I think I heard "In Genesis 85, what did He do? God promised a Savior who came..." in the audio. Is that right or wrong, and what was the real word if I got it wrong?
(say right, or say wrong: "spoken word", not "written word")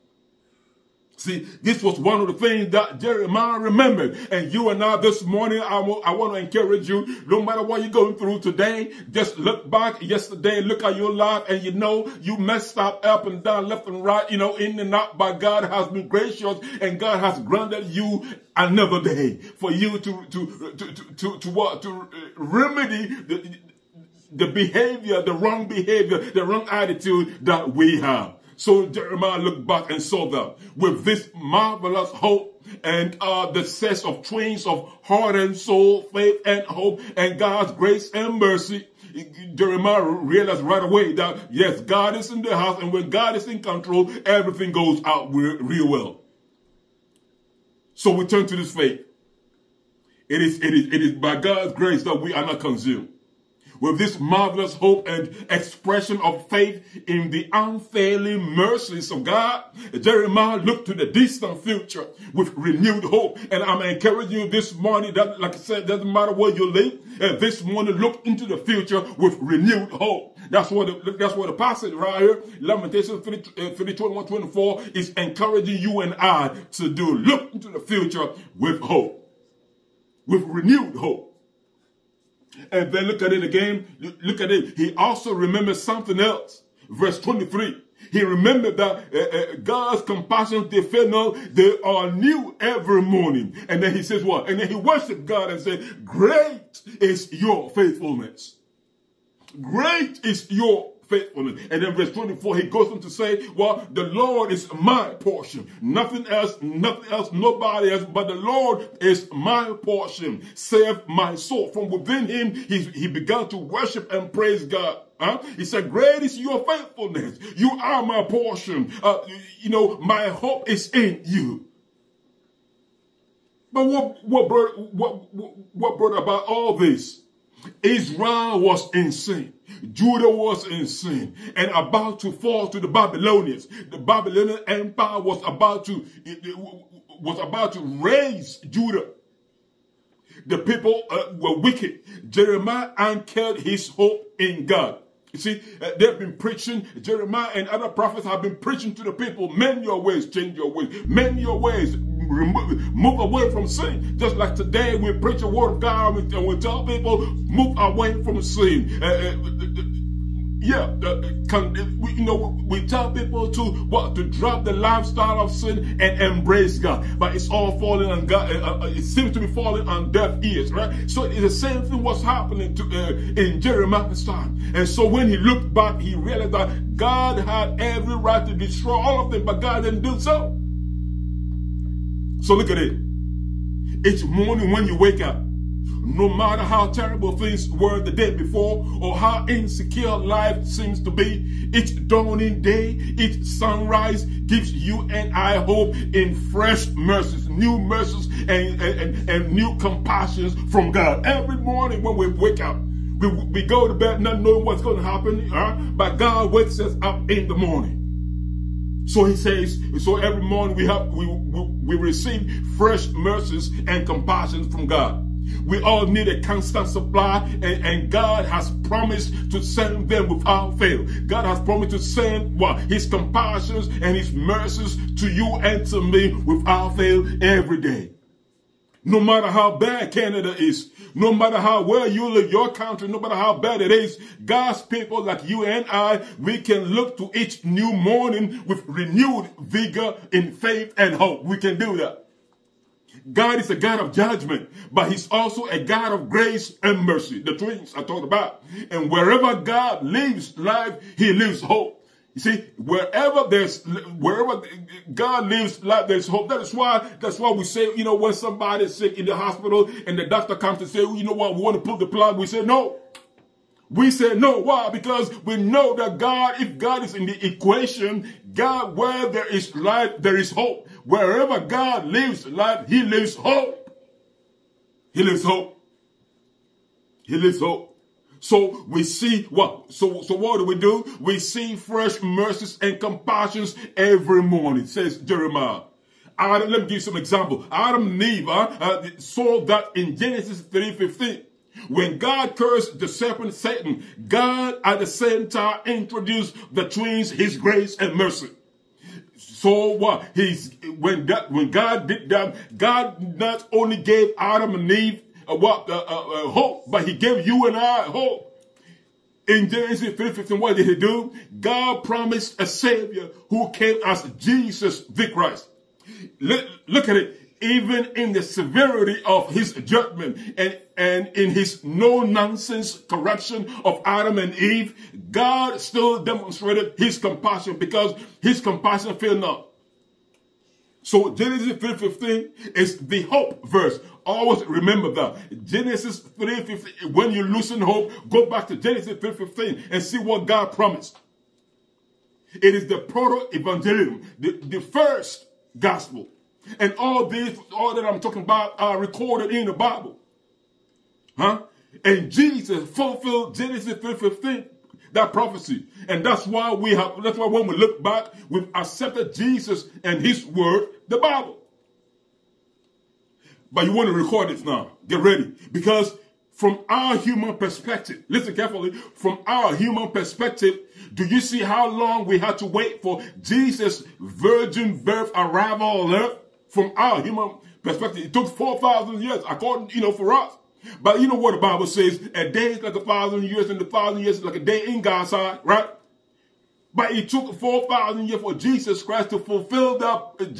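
wrong: "15", not "85".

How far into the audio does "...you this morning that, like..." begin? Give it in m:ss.
1:04.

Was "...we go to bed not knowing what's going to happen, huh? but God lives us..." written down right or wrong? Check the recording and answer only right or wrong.
wrong.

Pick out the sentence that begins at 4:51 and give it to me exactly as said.
When God cursed the serpent Satan, God at the same time introduced the twins, his grace and mercy.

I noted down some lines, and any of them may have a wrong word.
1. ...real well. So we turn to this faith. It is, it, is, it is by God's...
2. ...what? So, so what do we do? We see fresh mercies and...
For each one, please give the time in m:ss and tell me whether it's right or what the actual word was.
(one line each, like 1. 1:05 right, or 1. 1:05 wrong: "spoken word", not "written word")
1. 0:45 right
2. 4:39 right.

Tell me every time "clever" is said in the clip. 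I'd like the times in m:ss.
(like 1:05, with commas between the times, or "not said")
not said.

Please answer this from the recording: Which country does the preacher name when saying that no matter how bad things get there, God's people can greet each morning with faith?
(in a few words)
Canada.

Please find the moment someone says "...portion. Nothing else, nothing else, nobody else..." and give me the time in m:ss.
1:45.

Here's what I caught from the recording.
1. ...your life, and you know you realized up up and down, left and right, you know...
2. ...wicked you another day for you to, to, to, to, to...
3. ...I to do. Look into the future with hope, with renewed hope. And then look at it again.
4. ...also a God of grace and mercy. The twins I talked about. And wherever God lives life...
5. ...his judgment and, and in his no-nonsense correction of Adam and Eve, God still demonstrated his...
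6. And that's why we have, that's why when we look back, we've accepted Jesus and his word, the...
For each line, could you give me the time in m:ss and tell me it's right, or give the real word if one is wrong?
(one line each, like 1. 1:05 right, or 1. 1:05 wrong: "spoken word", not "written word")
1. 0:10 wrong: "messed", not "realized"
2. 0:17 wrong: "granted", not "wicked"
3. 1:16 right
4. 4:05 right
5. 5:19 right
6. 5:56 right.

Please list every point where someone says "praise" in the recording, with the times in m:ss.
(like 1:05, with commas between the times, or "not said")
1:54.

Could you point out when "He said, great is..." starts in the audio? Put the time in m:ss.
1:55.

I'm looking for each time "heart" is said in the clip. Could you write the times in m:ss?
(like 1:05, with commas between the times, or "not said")
0:35.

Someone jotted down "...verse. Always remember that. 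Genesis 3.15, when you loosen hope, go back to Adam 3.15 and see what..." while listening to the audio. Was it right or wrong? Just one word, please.
wrong.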